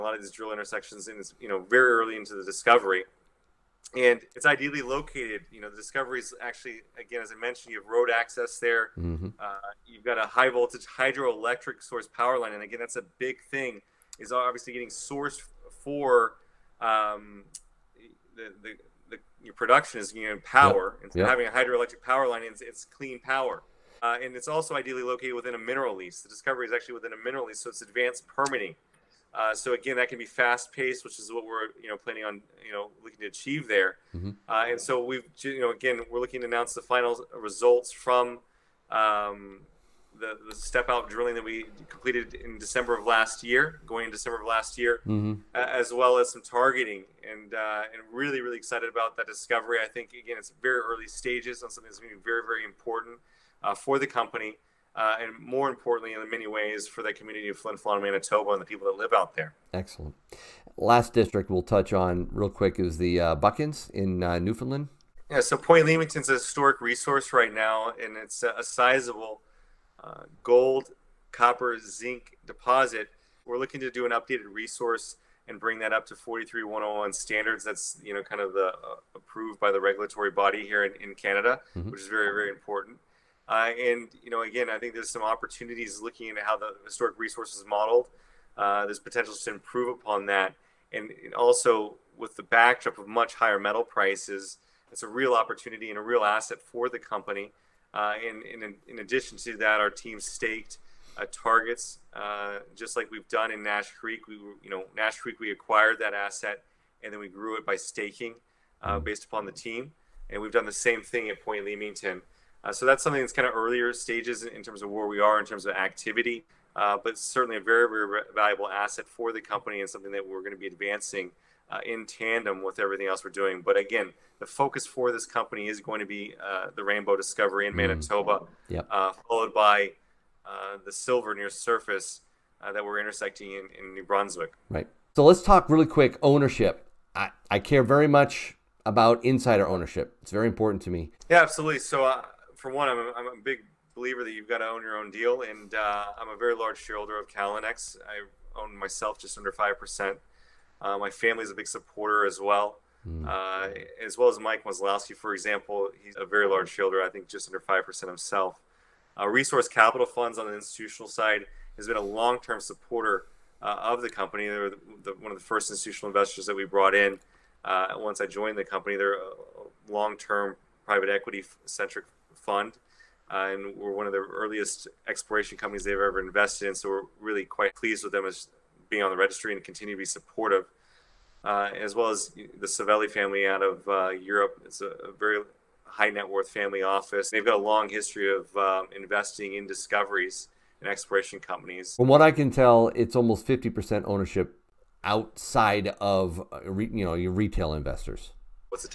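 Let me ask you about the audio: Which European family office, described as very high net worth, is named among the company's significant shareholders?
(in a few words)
Savelli family.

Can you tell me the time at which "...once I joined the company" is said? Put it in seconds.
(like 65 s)
167 s.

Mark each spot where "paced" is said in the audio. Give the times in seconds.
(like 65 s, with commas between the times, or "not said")
30 s.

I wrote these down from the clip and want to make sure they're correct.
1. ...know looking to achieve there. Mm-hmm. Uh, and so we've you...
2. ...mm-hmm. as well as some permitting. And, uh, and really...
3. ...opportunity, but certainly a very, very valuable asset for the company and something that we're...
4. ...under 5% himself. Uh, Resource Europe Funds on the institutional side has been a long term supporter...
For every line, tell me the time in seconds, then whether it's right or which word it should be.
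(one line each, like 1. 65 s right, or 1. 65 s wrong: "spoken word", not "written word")
1. 32 s right
2. 45 s wrong: "targeting", not "permitting"
3. 115 s wrong: "activity", not "opportunity"
4. 157 s wrong: "Capital", not "Europe".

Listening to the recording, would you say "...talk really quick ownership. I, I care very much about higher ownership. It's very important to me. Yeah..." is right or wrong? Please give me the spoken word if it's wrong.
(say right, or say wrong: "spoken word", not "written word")
wrong: "insider", not "higher".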